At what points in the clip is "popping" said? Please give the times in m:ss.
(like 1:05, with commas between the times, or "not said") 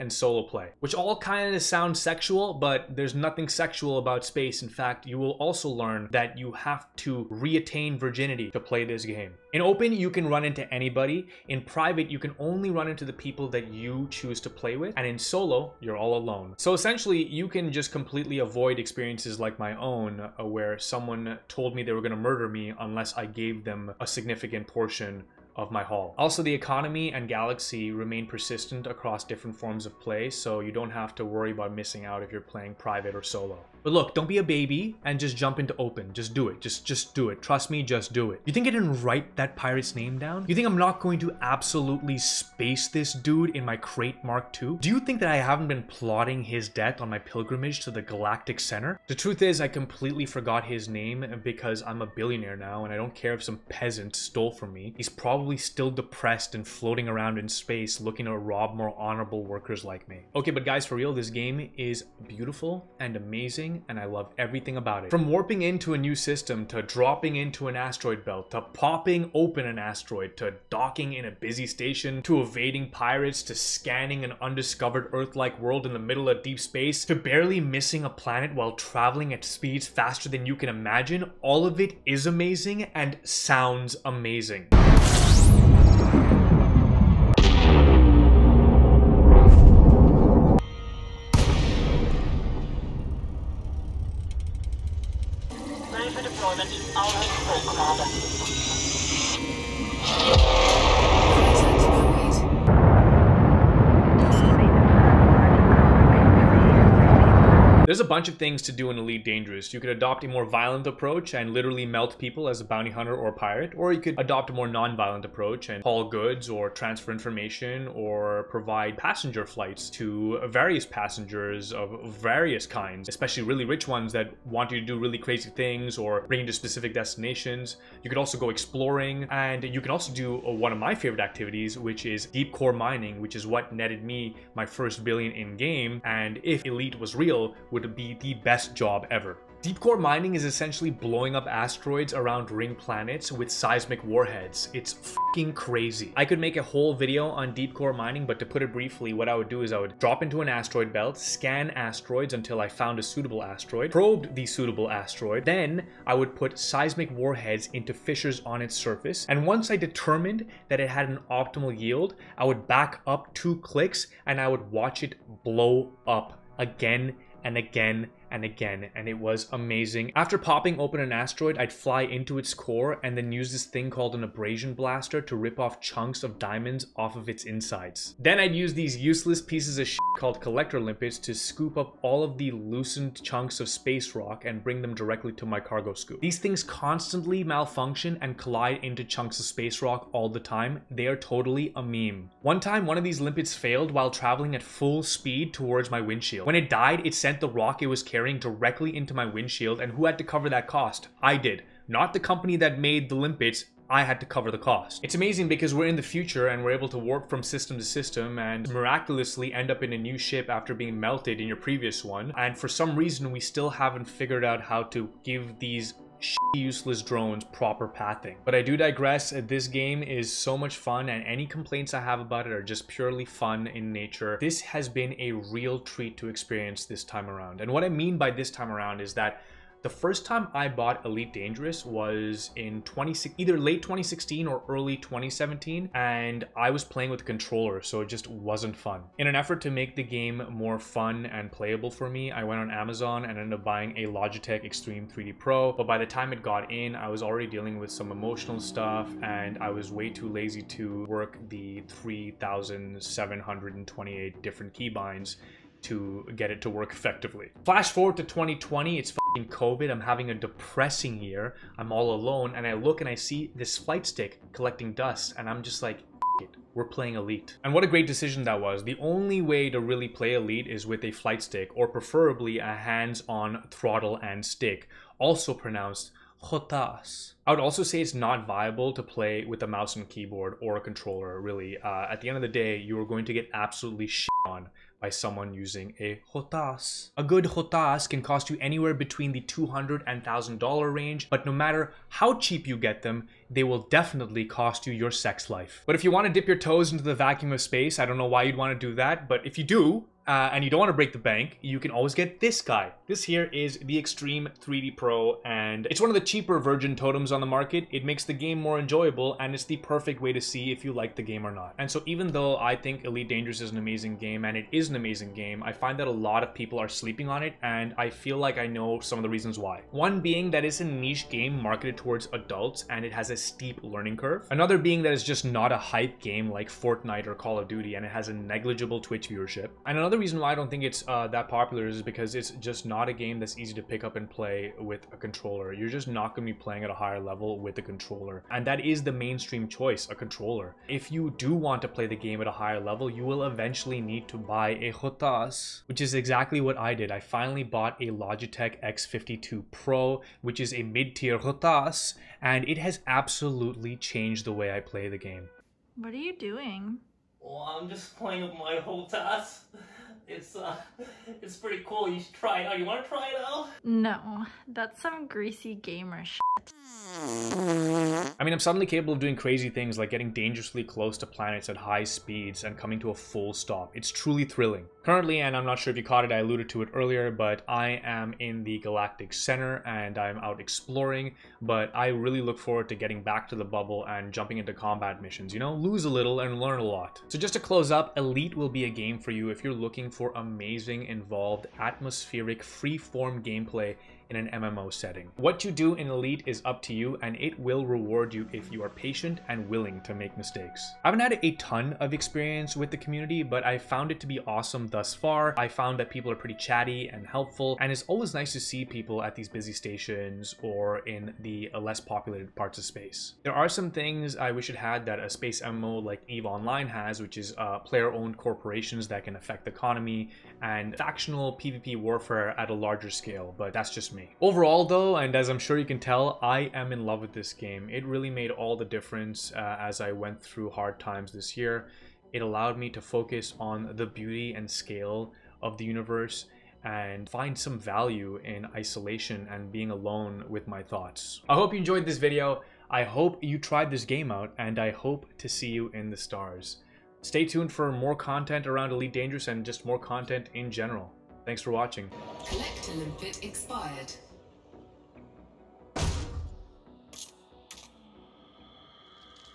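1:08, 2:50.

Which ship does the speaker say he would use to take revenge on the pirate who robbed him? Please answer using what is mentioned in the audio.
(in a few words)
Krait Mark Two.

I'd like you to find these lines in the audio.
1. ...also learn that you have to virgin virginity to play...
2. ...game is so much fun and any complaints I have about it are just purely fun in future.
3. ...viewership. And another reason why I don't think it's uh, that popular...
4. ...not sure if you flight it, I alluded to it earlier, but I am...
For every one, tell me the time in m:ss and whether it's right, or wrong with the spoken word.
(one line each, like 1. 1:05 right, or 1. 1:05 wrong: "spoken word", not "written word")
1. 0:05 wrong: "reattain", not "virgin"
2. 3:39 wrong: "nature", not "future"
3. 5:29 right
4. 6:15 wrong: "caught", not "flight".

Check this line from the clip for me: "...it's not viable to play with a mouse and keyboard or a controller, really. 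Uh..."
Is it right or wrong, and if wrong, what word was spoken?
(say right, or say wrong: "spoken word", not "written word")
right.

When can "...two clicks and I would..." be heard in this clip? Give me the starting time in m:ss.
2:43.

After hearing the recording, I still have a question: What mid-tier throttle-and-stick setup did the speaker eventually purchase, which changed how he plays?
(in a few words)
Logitech X52 Pro.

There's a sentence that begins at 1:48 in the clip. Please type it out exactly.
bunch of things to do in Elite Dangerous.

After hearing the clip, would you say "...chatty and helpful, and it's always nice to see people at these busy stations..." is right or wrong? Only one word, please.
right.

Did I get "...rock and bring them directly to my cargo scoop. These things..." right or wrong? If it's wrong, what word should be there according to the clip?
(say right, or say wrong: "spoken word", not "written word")
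right.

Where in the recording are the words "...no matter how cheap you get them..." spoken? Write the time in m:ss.
4:51.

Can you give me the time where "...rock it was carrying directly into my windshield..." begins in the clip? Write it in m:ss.
3:17.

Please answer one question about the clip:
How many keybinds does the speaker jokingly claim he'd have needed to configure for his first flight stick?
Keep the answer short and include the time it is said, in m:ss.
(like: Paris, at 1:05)
3,728, at 4:11.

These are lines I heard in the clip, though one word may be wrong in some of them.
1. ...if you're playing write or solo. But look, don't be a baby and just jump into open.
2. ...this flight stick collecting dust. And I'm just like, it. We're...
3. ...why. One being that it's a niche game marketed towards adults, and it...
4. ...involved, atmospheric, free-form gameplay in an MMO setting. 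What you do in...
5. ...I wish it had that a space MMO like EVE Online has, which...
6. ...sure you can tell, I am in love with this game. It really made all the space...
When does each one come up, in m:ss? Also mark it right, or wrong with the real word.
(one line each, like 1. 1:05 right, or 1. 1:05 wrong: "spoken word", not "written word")
1. 0:32 wrong: "private", not "write"
2. 4:23 right
3. 5:19 right
4. 6:31 right
5. 6:54 right
6. 7:05 wrong: "difference", not "space".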